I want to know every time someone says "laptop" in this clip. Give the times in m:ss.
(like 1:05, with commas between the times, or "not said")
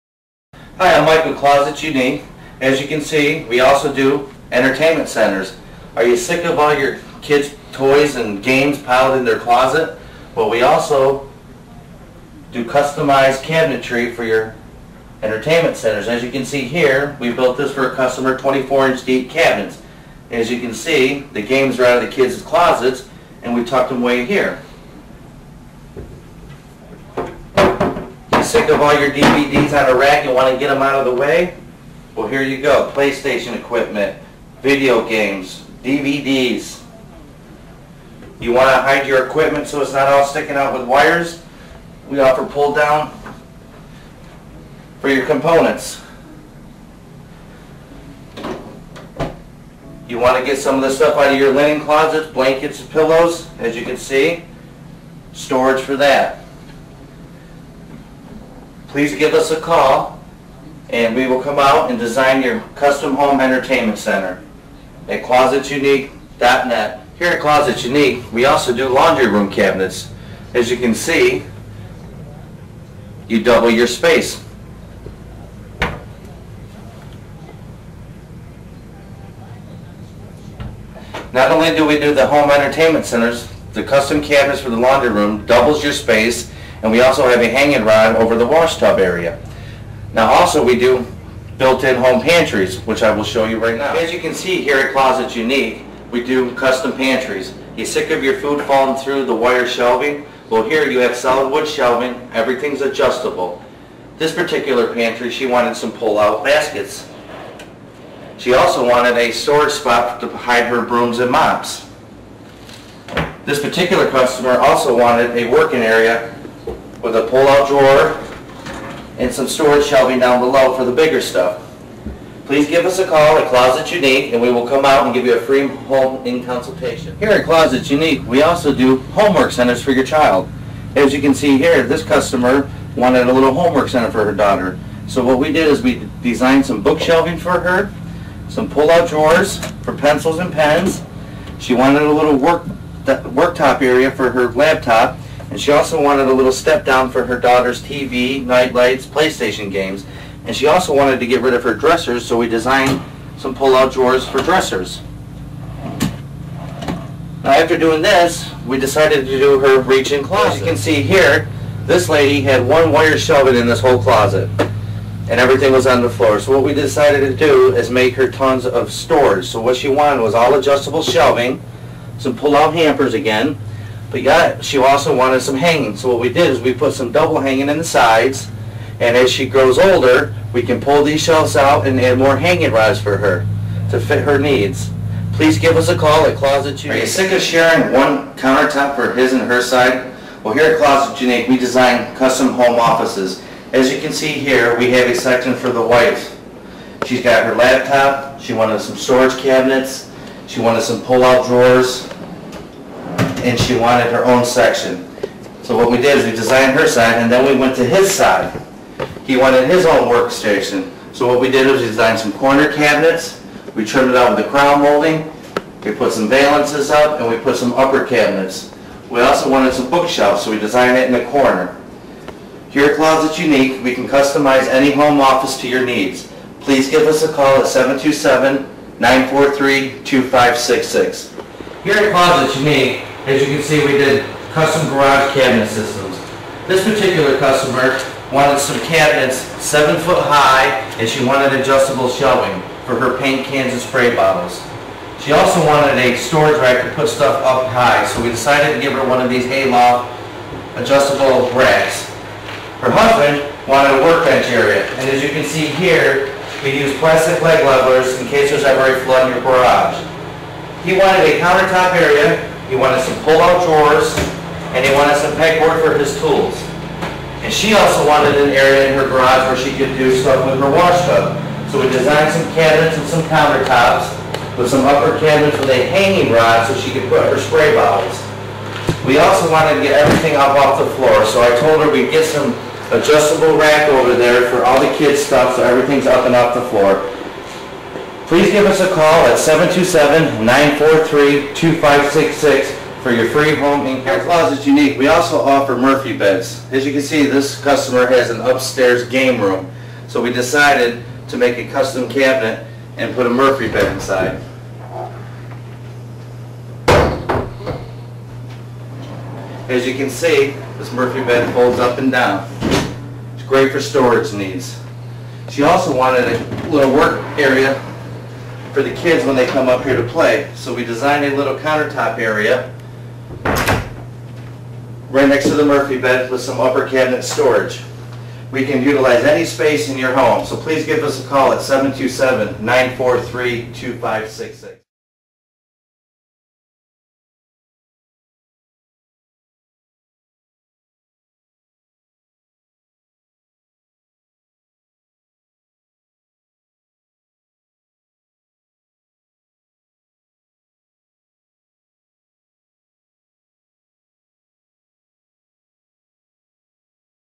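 2:24, 3:17.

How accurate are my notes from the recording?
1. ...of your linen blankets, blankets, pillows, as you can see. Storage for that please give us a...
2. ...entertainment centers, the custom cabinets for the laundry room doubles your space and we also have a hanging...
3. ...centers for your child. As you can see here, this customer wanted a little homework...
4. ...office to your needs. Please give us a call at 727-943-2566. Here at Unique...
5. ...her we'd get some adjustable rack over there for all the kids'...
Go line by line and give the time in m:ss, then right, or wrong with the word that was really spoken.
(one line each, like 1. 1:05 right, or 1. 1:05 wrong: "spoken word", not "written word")
1. 0:51 wrong: "closets", not "blankets"
2. 1:22 right
3. 2:09 right
4. 3:45 wrong: "Closets", not "Unique"
5. 4:41 right.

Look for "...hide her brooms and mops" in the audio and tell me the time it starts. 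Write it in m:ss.
1:50.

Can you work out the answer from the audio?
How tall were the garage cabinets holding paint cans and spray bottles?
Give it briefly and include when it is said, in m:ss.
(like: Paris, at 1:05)
7 feet, at 3:59.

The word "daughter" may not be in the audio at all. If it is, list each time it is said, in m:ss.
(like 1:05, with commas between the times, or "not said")
2:14, 2:27.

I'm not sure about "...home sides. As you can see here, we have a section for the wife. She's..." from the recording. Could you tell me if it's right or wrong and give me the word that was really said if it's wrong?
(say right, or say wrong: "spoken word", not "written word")
wrong: "offices", not "sides".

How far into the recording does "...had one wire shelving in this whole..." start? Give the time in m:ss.
2:42.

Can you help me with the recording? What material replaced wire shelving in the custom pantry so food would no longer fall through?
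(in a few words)
solid wood.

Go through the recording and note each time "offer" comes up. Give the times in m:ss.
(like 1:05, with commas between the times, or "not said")
0:42, 4:55.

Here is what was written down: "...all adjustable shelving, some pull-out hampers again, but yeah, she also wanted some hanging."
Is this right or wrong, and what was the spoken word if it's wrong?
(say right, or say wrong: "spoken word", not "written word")
right.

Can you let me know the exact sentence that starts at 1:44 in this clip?
This particular pantry, she wanted some pull-out baskets.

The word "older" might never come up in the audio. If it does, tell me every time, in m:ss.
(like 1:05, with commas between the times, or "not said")
2:59.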